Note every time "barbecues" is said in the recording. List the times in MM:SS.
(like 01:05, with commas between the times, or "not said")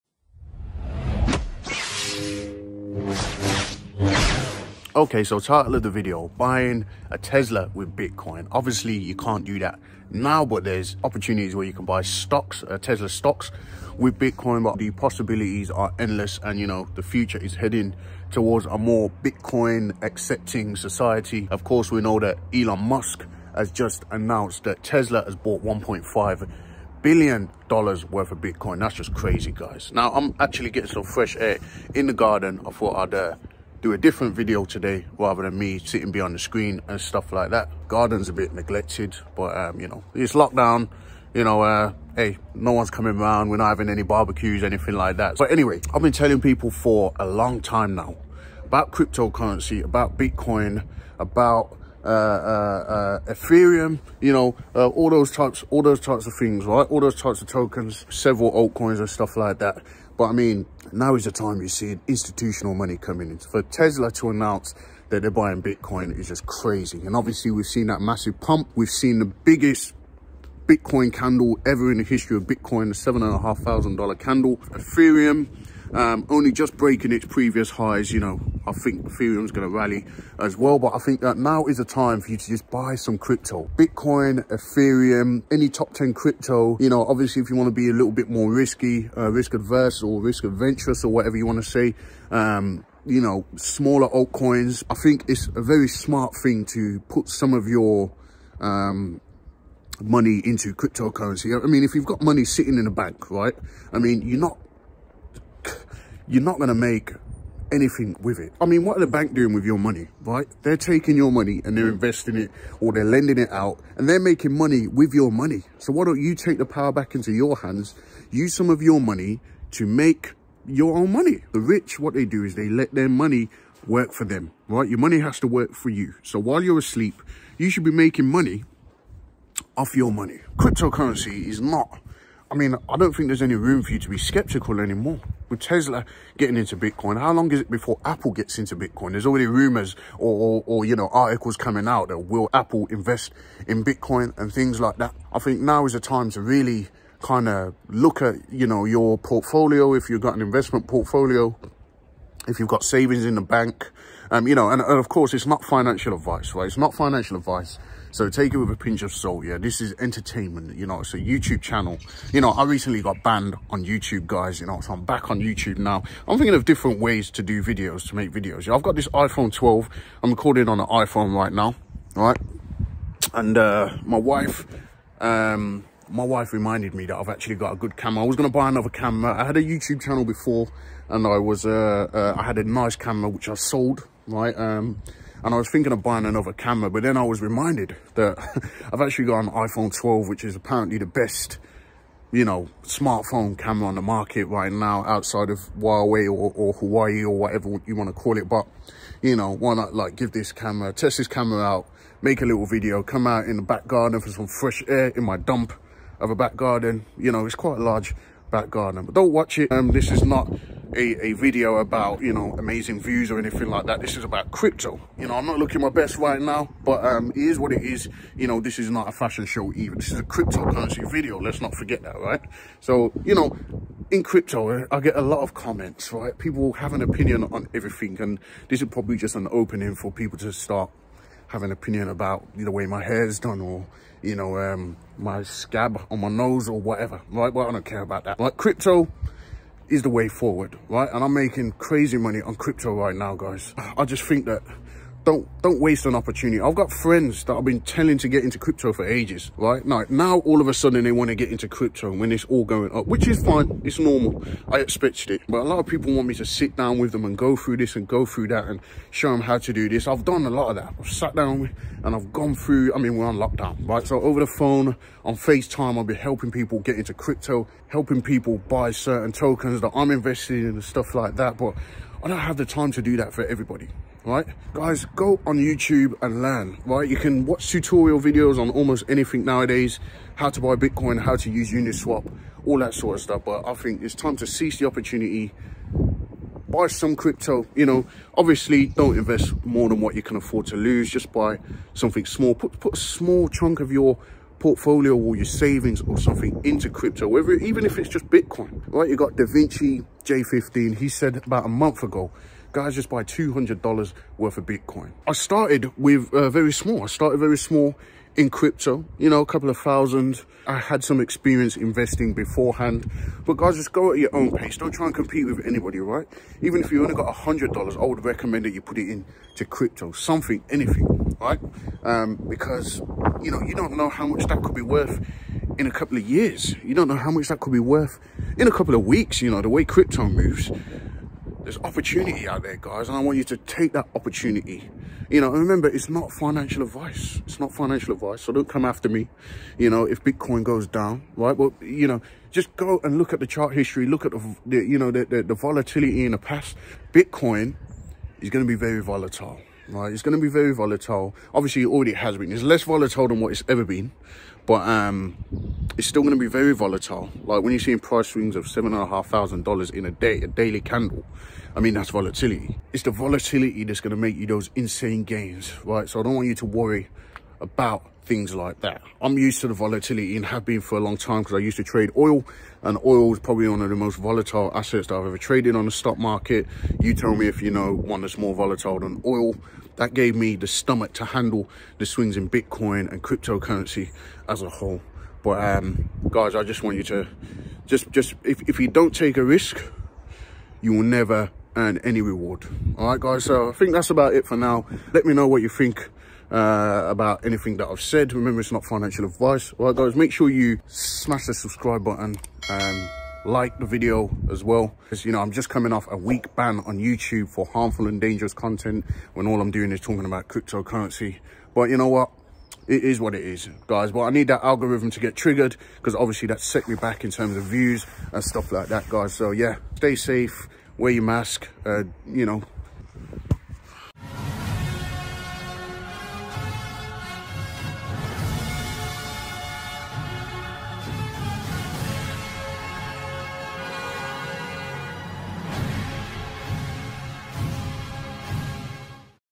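00:44.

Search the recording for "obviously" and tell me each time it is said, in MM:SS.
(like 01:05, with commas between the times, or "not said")
00:08, 01:07, 01:27, 04:48, 05:51, 06:56.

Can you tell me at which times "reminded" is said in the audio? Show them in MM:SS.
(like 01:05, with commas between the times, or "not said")
02:56, 03:07.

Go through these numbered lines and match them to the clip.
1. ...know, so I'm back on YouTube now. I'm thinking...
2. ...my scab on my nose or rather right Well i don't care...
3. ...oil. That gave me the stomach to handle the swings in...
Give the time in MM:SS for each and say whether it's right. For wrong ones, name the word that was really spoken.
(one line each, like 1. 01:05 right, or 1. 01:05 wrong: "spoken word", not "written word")
1. 02:44 right
2. 03:55 wrong: "whatever", not "rather"
3. 06:19 right.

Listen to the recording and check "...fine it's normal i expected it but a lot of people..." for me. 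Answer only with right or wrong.
right.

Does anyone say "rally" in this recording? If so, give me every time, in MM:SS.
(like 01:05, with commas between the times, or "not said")
01:19.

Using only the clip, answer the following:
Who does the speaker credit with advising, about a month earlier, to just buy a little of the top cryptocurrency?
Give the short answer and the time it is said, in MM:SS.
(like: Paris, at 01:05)
Da Vinci J15, at 04:59.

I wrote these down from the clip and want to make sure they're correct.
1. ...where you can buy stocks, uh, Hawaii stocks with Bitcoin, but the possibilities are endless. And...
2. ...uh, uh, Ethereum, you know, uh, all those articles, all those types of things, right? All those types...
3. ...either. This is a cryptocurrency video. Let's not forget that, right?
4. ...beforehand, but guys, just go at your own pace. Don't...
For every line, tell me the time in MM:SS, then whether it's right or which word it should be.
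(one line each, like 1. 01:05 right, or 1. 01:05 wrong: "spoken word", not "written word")
1. 00:11 wrong: "Tesla", not "Hawaii"
2. 00:52 wrong: "types", not "articles"
3. 03:39 right
4. 05:12 right.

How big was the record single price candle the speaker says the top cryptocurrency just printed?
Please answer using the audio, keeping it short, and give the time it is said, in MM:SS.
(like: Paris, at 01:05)
$7,500, at 01:13.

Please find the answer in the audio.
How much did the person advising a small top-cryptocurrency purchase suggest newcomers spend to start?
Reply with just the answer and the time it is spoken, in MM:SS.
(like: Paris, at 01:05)
$200, at 05:03.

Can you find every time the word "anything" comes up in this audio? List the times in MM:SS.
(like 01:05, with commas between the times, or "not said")
00:44, 01:47, 03:33, 04:39, 05:20, 06:37.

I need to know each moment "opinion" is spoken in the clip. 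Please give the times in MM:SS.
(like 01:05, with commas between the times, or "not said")
03:47, 03:51.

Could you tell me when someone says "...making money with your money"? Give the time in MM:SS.
01:54.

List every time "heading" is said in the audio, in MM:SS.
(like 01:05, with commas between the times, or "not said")
00:17.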